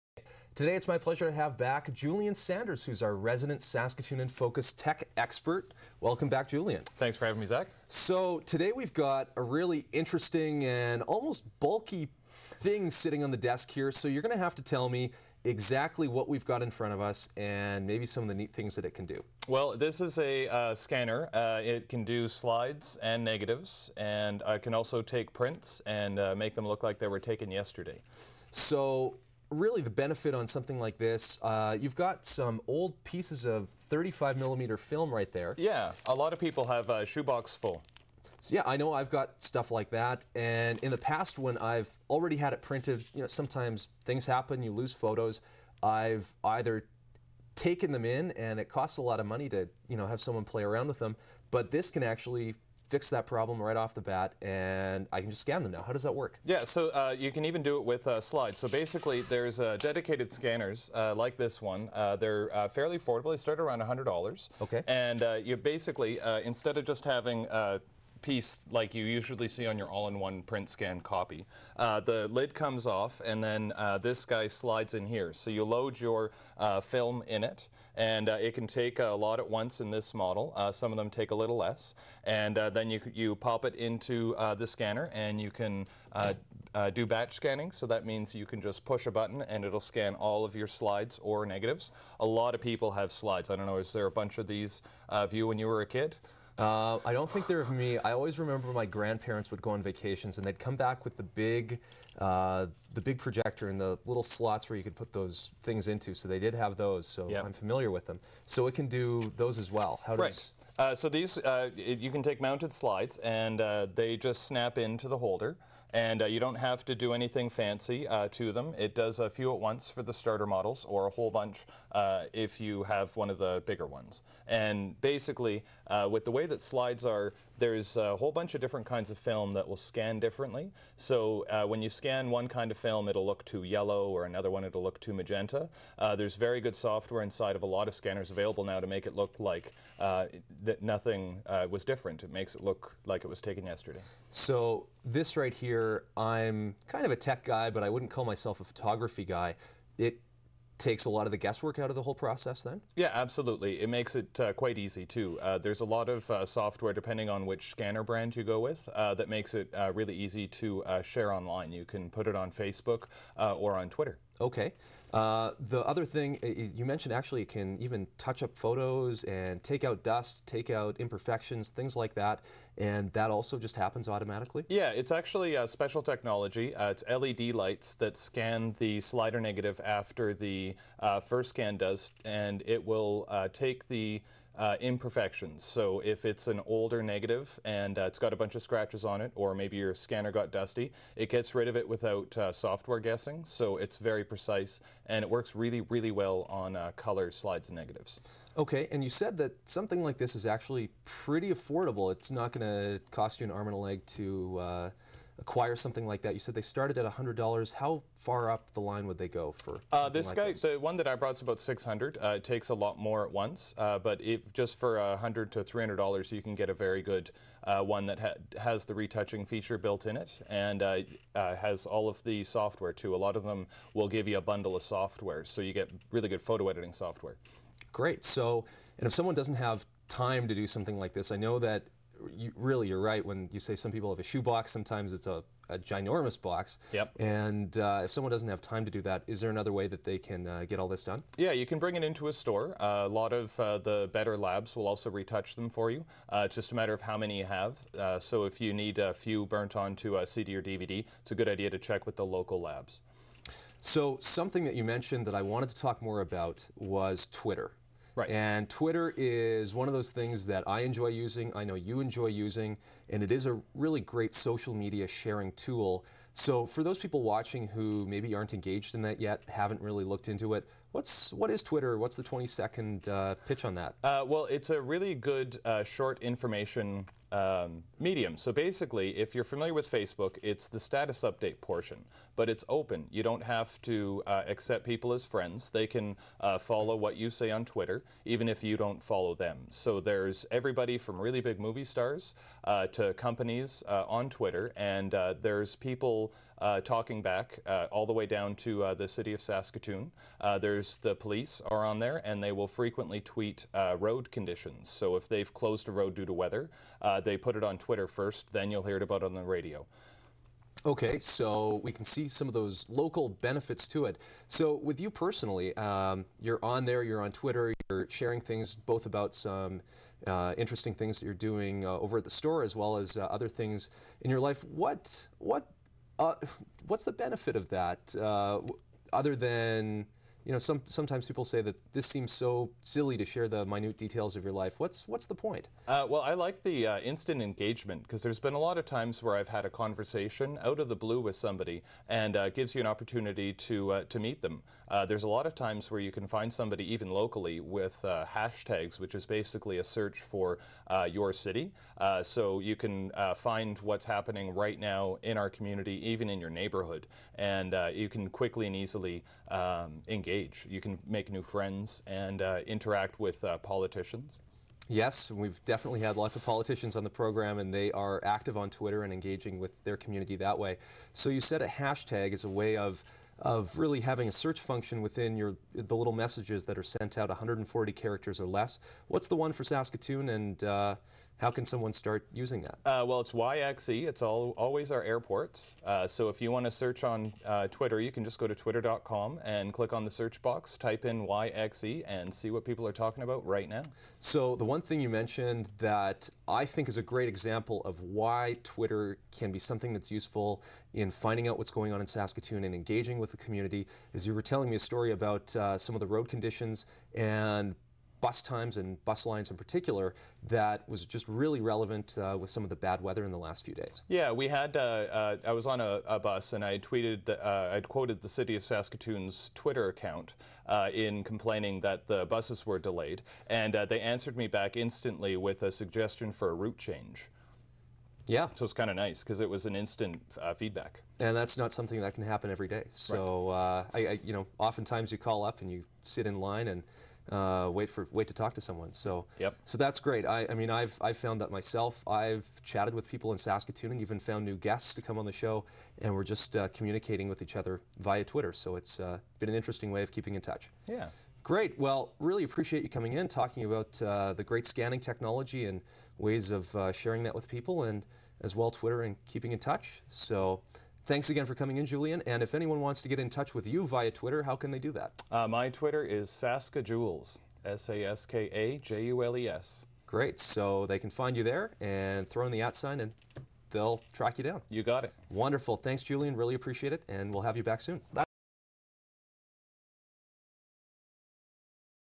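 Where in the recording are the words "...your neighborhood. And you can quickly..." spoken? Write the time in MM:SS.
05:56.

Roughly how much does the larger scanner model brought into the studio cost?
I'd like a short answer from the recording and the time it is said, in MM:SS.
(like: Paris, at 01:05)
600, at 03:31.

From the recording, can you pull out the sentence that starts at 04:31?
What's the 20 second uh, pitch on that?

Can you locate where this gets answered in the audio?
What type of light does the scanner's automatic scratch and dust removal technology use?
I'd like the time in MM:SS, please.
02:57.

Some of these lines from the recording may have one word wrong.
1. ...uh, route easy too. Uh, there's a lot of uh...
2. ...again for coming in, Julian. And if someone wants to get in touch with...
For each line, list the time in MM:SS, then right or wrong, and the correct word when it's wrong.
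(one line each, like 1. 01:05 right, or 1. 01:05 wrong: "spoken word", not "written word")
1. 02:34 wrong: "quite", not "route"
2. 07:41 wrong: "anyone", not "someone".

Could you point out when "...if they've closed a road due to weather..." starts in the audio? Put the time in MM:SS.
05:05.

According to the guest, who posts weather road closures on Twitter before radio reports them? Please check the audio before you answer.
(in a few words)
the police.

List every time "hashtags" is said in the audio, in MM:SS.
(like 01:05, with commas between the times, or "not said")
05:48, 06:11.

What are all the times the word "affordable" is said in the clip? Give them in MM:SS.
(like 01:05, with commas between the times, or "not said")
01:02, 03:21.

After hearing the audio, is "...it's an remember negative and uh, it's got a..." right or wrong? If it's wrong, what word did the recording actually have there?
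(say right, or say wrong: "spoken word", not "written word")
wrong: "older", not "remember".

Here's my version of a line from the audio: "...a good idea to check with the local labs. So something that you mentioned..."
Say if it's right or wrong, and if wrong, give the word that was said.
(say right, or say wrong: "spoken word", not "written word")
right.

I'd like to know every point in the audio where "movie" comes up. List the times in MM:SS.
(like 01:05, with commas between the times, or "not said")
04:51.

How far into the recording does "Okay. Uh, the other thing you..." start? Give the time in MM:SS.
02:44.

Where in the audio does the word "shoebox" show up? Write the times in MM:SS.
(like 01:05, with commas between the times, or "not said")
00:37, 03:54.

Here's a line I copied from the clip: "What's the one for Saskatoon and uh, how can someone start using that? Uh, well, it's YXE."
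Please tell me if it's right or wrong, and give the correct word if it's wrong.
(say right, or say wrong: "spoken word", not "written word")
right.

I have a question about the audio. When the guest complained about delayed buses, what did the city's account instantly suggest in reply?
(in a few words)
a route change.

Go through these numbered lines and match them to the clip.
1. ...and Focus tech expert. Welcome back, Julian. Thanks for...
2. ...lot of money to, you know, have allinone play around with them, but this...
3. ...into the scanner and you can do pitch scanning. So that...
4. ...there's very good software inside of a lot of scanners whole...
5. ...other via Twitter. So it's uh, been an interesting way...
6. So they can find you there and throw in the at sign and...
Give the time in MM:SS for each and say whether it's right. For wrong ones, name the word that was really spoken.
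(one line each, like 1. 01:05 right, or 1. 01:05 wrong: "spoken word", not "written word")
1. 00:04 right
2. 00:49 wrong: "someone", not "allinone"
3. 01:23 wrong: "batch", not "pitch"
4. 02:16 wrong: "available", not "whole"
5. 07:27 right
6. 07:50 right.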